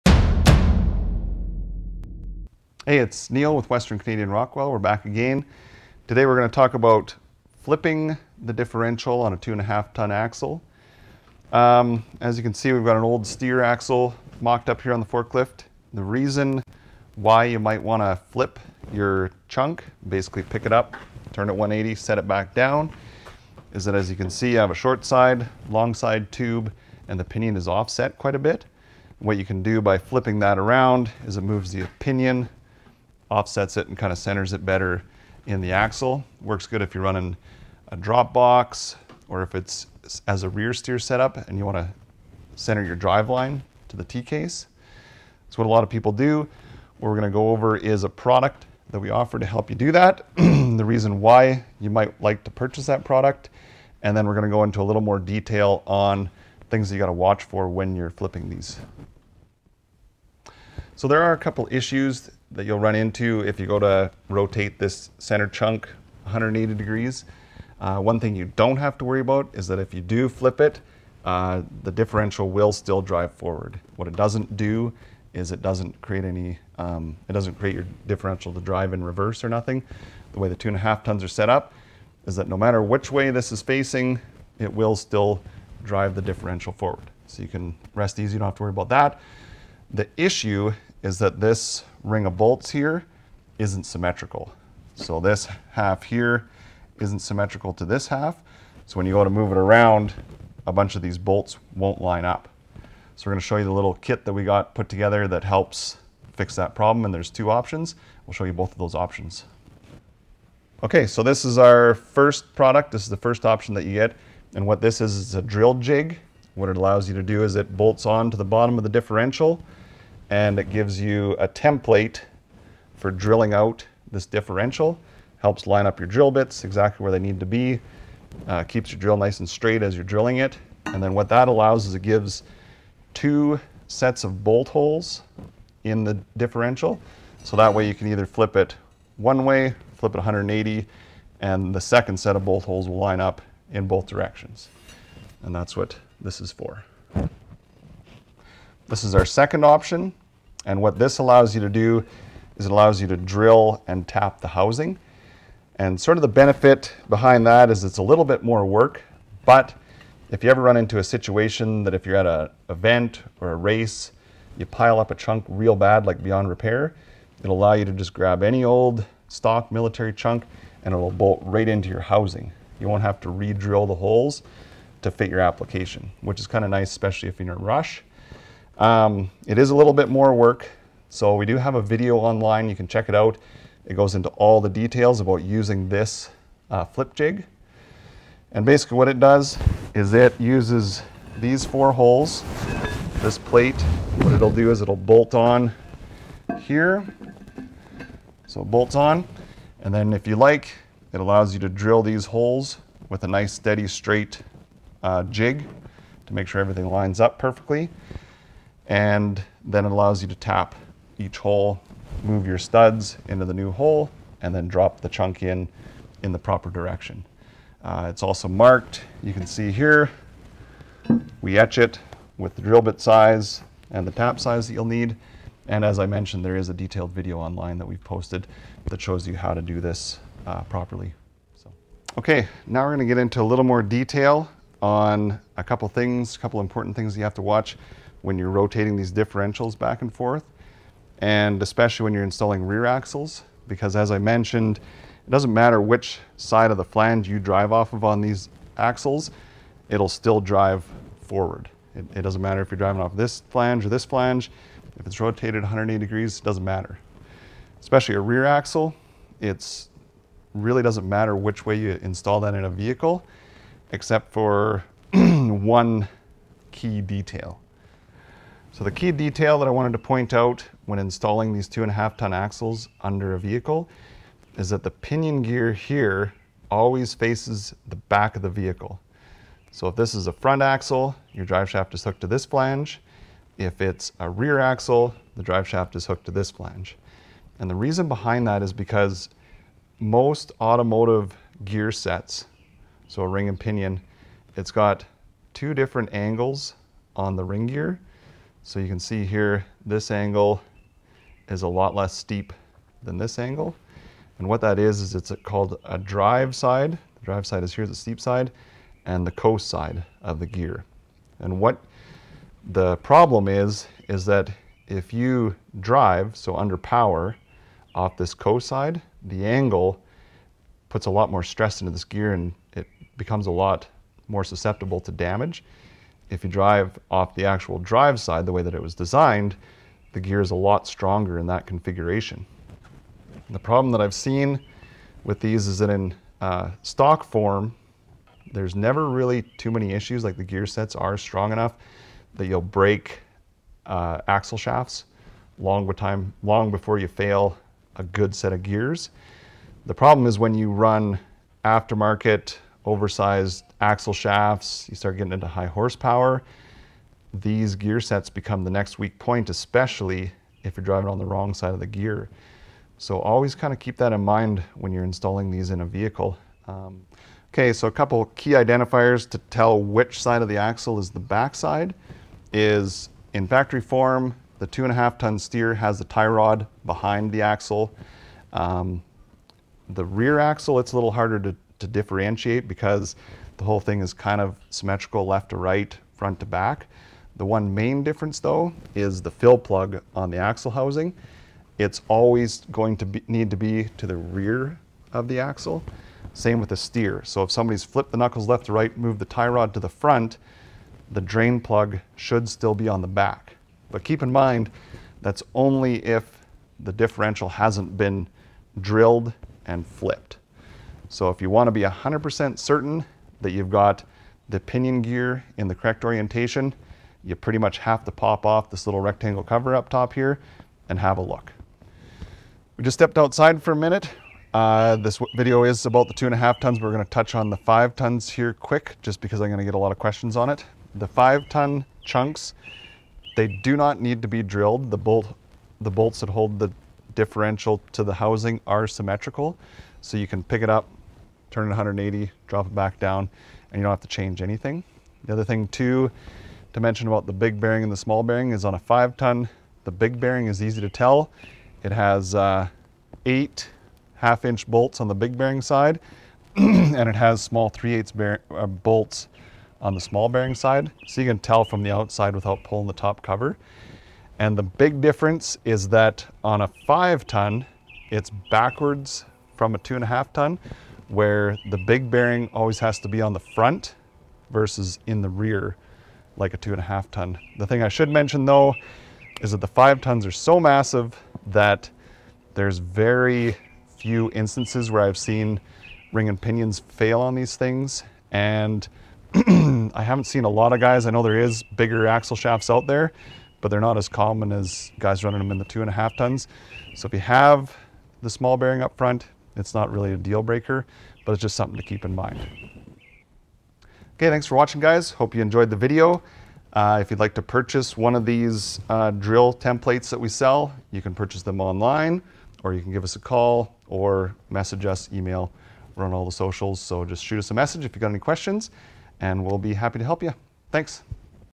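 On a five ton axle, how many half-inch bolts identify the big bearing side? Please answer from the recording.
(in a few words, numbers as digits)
8.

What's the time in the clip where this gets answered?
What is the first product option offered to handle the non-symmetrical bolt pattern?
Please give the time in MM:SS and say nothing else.
01:55.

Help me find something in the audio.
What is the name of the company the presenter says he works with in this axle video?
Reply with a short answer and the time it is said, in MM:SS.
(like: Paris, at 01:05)
Western Canadian Rockwell, at 00:03.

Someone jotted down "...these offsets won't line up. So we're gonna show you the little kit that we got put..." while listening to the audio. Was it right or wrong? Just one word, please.
wrong.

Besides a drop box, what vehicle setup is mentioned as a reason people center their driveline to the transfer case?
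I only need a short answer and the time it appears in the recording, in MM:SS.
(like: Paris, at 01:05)
rear steer, at 00:40.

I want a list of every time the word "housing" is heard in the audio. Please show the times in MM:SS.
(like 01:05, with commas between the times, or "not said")
02:34, 02:51, 06:30, 07:18.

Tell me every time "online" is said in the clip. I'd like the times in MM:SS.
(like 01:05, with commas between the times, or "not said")
03:02, 03:47, 08:31.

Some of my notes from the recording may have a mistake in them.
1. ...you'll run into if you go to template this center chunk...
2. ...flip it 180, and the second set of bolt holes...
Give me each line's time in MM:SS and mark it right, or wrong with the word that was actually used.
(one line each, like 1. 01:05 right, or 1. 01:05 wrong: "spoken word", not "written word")
1. 01:02 wrong: "rotate", not "template"
2. 02:19 right.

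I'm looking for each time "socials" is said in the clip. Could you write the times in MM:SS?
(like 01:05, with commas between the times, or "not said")
08:36.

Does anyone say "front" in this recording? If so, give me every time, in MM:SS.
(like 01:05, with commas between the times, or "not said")
04:40, 06:26, 06:39, 07:53, 08:18.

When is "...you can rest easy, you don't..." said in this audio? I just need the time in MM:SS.
01:27.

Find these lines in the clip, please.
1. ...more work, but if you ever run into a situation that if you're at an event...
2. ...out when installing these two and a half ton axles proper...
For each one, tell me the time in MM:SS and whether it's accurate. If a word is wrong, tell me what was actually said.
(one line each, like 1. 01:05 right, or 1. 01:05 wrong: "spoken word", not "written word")
1. 02:38 right
2. 04:30 wrong: "under", not "proper".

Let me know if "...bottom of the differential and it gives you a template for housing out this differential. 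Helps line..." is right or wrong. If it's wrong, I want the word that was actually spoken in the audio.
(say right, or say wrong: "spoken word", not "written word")
wrong: "drilling", not "housing".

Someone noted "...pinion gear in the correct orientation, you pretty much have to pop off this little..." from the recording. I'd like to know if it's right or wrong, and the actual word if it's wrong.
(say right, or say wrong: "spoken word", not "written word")
right.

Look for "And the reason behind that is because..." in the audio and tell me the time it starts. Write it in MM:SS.
04:47.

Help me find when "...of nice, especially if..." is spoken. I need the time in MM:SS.
02:56.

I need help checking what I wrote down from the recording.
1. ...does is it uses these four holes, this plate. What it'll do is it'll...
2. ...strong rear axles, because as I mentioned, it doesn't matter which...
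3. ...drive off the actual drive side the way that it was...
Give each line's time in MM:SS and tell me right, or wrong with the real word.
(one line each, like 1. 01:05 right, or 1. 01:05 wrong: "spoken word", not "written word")
1. 03:09 right
2. 04:02 wrong: "installing", not "strong"
3. 05:26 right.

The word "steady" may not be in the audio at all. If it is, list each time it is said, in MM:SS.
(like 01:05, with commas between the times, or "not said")
03:23.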